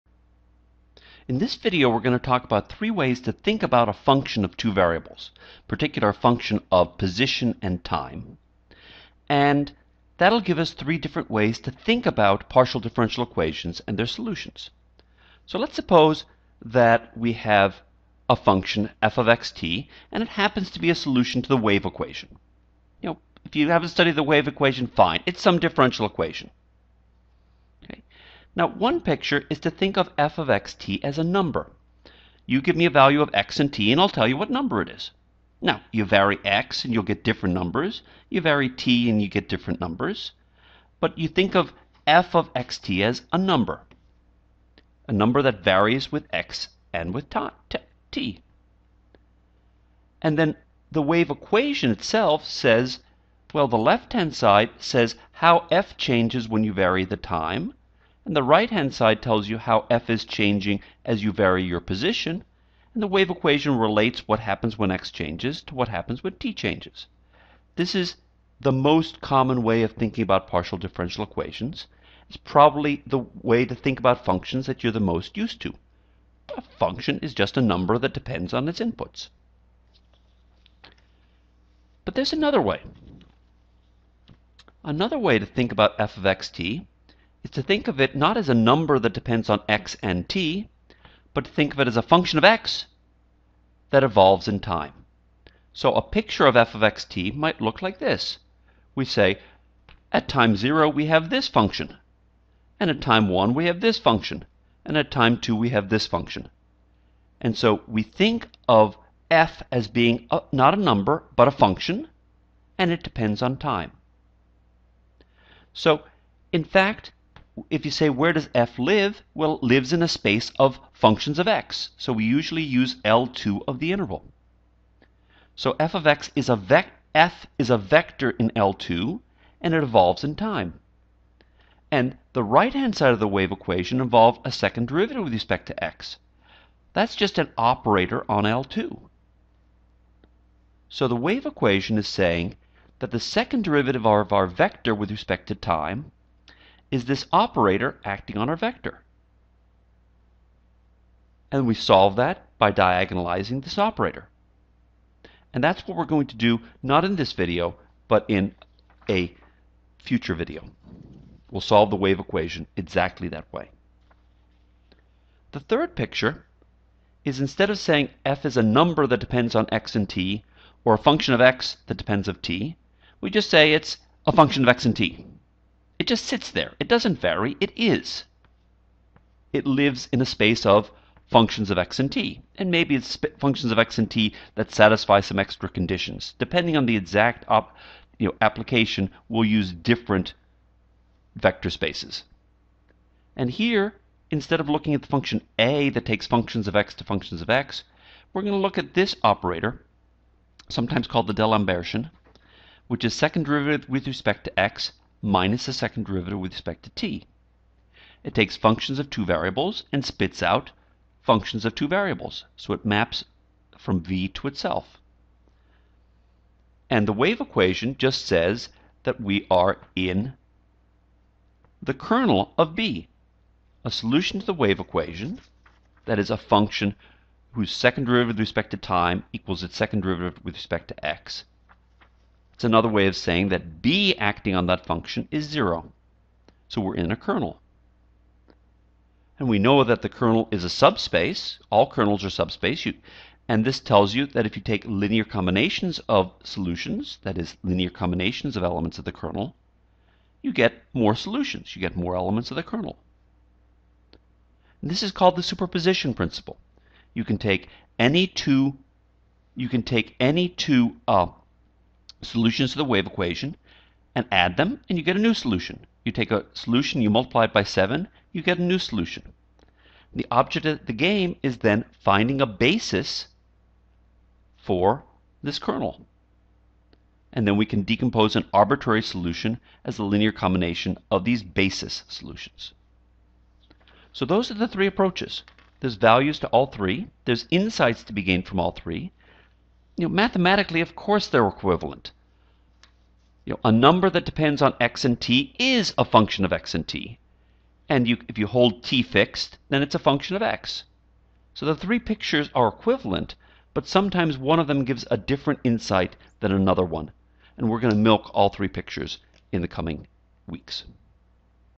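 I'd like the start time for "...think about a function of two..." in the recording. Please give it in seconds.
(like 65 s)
3 s.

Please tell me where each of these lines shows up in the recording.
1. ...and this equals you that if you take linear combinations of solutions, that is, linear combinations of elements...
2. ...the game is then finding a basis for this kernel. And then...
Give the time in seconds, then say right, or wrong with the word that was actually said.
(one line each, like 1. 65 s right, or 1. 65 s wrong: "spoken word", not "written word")
1. 243 s wrong: "tells", not "equals"
2. 270 s right.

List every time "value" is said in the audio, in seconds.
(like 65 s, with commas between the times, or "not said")
32 s, 285 s.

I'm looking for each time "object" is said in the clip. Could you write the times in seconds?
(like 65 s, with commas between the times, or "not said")
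270 s.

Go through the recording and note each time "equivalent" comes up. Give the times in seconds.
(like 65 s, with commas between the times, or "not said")
291 s, 302 s.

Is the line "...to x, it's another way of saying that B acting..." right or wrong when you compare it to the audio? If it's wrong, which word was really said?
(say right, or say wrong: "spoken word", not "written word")
right.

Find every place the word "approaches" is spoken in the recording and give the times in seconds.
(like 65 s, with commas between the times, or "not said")
284 s.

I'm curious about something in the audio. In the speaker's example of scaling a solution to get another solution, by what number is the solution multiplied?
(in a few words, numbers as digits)
7.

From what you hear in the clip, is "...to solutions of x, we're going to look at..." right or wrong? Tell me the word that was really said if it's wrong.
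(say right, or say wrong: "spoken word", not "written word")
wrong: "functions", not "solutions".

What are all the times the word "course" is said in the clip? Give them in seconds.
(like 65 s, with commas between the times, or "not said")
290 s.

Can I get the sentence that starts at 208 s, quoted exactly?
It takes functions of two variables and spits out functions of two variables, so it maps from v to itself.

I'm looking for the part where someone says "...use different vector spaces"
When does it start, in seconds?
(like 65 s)
189 s.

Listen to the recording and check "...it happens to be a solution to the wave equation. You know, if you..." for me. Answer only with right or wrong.
right.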